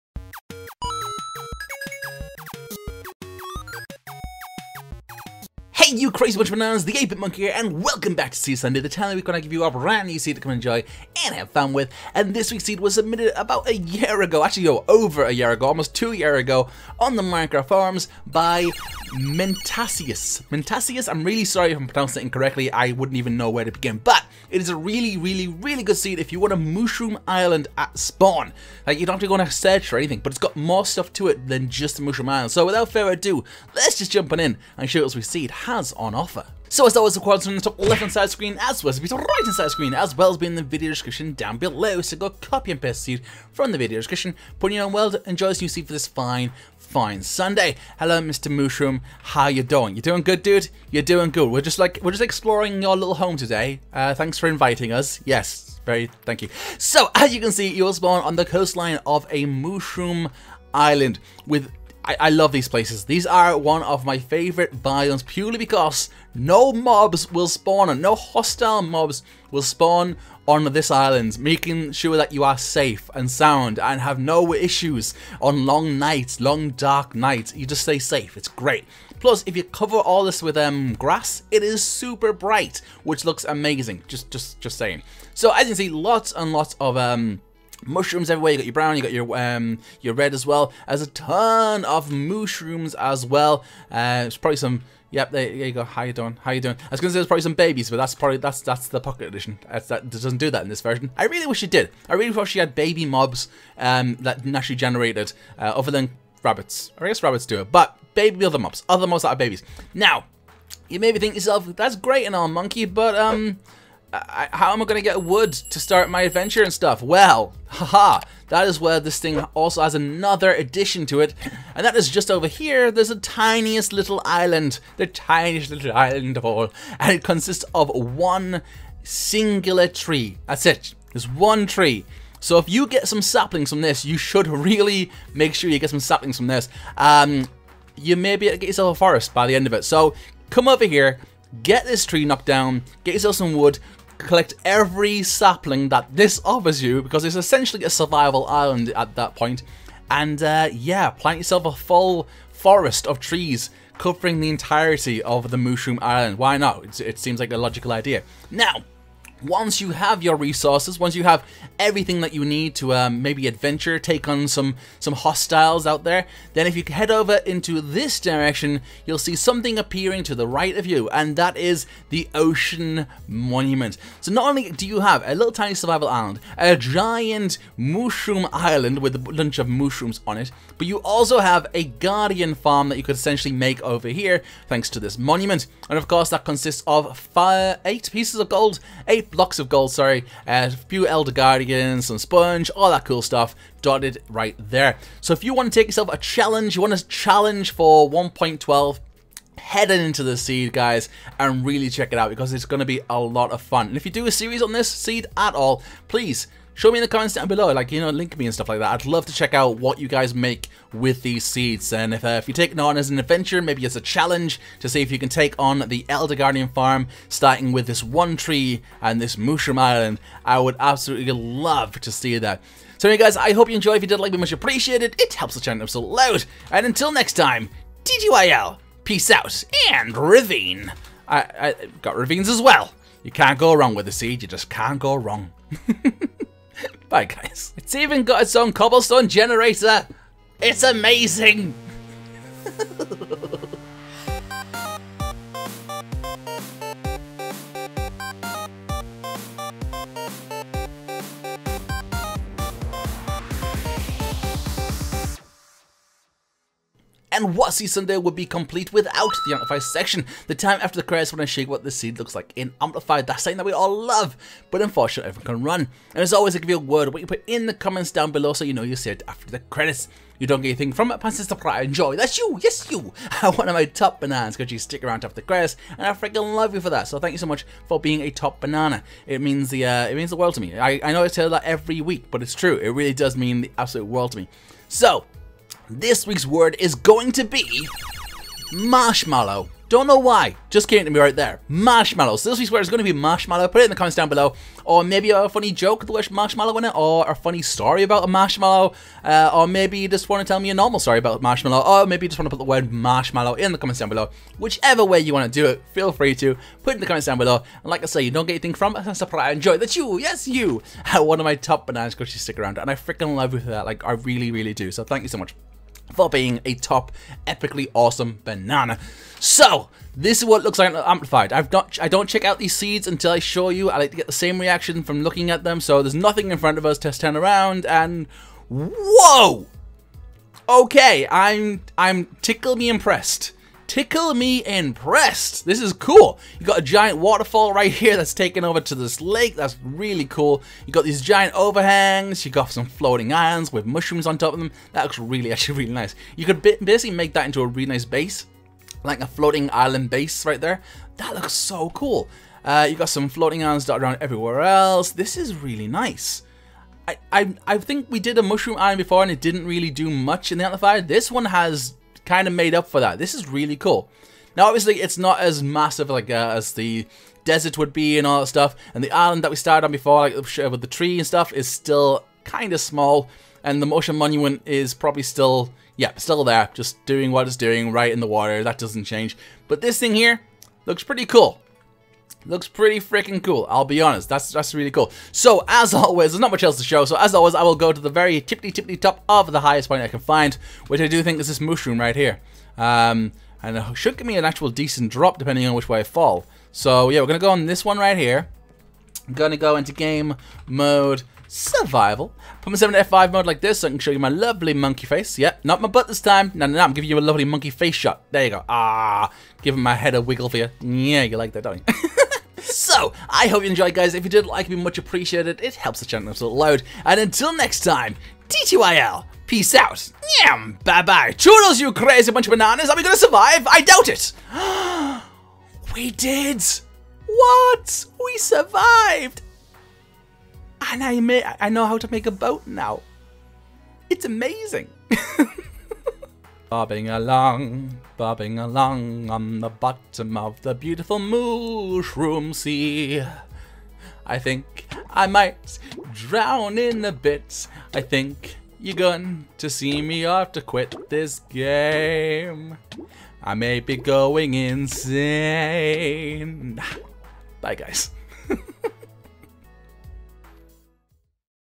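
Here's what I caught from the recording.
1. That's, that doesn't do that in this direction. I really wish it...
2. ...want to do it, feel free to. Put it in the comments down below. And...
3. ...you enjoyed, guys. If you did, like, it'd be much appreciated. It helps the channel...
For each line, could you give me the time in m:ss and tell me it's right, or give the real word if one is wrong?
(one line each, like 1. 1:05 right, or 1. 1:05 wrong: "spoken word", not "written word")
1. 1:39 wrong: "version", not "direction"
2. 5:05 right
3. 6:53 right.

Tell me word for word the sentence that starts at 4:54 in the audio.
Or maybe a funny joke with the marshmallow in it, or a funny story about a marshmallow.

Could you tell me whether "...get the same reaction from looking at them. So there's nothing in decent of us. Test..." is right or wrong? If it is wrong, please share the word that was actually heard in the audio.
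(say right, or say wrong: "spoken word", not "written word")
wrong: "front", not "decent".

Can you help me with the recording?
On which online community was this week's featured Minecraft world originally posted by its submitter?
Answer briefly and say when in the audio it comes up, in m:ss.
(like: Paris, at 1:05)
Minecraft forums, at 0:17.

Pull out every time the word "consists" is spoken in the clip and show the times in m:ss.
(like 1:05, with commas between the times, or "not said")
2:07, 3:06.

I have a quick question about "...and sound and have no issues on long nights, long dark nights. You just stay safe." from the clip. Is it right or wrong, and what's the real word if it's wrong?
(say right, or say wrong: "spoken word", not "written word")
right.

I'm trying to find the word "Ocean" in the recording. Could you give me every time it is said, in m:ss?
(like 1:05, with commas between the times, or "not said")
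2:52, 6:13.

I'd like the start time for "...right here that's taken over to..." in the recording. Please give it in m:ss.
5:37.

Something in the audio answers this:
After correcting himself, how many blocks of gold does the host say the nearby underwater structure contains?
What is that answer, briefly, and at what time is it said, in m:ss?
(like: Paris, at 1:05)
8, at 3:09.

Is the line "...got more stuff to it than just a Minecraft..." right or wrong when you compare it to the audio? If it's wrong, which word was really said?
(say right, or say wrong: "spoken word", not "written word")
wrong: "Mushroom", not "Minecraft".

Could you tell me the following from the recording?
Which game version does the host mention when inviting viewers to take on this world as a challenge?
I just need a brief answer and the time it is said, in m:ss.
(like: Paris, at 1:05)
1.12, at 3:18.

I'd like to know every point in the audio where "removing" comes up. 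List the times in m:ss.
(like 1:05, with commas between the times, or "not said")
not said.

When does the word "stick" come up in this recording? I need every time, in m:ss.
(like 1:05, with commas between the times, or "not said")
4:34, 5:12.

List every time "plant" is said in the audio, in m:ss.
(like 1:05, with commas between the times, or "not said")
2:31.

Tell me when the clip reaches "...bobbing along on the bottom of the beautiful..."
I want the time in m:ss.
7:18.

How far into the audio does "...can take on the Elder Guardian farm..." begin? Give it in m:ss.
3:35.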